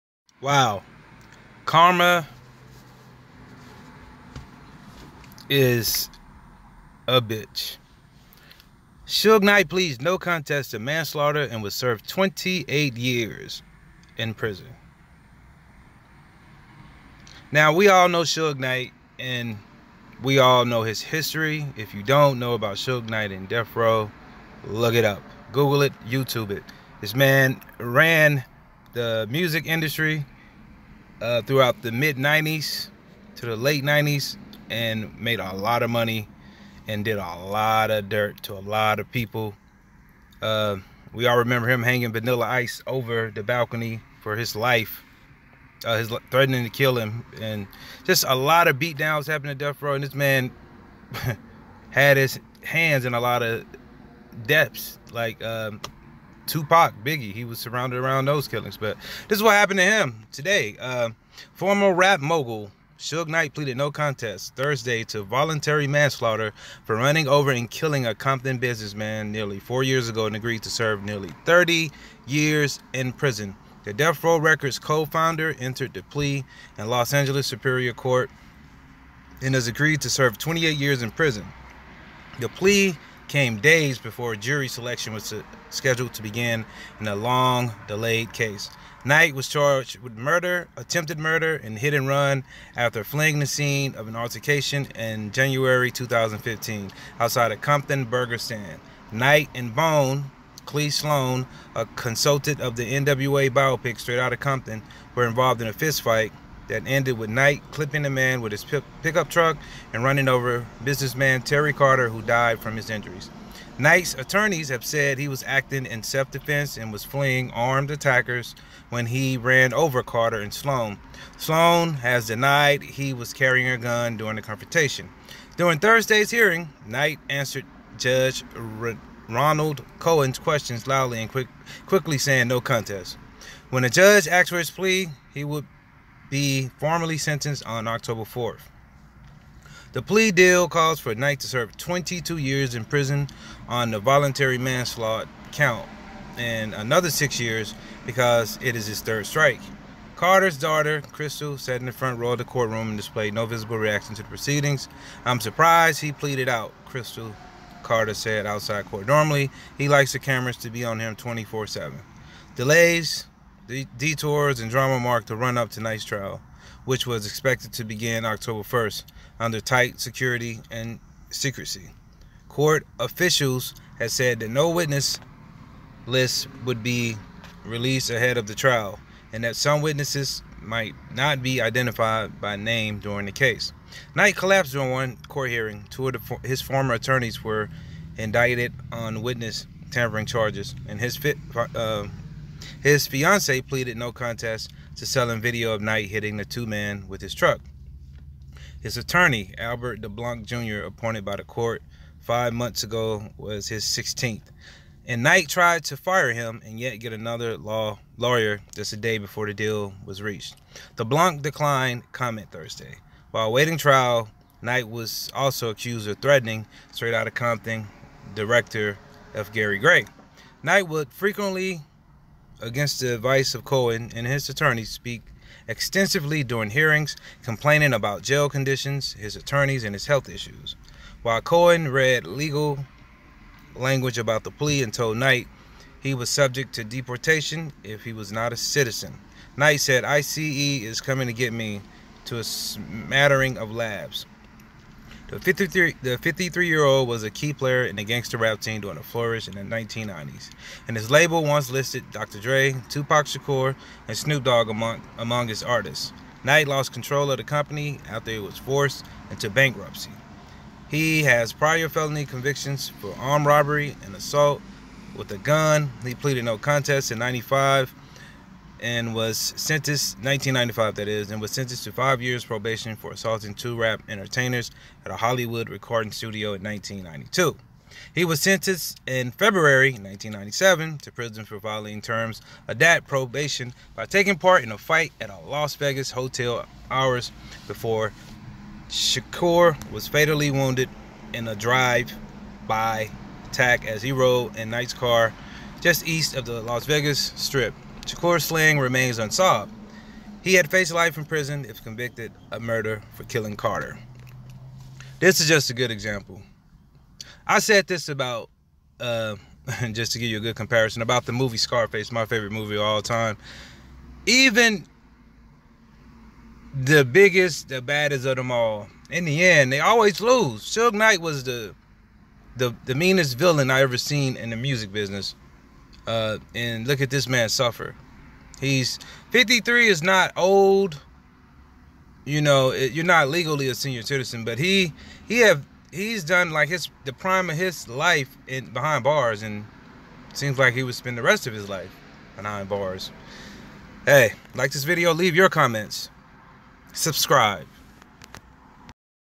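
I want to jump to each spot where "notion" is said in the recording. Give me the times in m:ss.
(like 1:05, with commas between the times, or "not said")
not said.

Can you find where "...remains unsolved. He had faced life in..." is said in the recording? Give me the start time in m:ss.
4:58.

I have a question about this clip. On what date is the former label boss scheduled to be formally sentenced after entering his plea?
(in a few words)
October 4th.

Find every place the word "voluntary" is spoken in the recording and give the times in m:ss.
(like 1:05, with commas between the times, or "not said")
1:05, 2:23.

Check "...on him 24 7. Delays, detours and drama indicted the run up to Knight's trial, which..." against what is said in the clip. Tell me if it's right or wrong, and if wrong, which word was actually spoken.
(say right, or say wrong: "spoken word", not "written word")
wrong: "marked", not "indicted".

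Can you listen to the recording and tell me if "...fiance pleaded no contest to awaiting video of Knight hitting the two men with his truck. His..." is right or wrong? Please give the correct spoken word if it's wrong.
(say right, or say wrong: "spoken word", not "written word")
wrong: "selling", not "awaiting".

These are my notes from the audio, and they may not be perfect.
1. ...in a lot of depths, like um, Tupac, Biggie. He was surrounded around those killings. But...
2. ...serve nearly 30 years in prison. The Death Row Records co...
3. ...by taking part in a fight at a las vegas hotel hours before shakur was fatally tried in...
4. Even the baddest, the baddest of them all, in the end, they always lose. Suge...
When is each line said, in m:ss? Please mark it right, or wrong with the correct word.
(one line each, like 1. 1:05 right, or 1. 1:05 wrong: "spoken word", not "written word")
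1. 0:53 right
2. 1:10 right
3. 4:43 wrong: "wounded", not "tried"
4. 5:14 wrong: "biggest", not "baddest".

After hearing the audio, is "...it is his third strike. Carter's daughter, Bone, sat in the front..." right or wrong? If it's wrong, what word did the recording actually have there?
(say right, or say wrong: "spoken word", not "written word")
wrong: "Crystal", not "Bone".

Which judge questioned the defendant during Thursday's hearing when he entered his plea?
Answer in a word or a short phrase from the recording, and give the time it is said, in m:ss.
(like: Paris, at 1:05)
Ronald Cohen, at 2:09.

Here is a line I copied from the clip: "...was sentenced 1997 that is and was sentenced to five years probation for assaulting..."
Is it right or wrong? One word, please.
wrong.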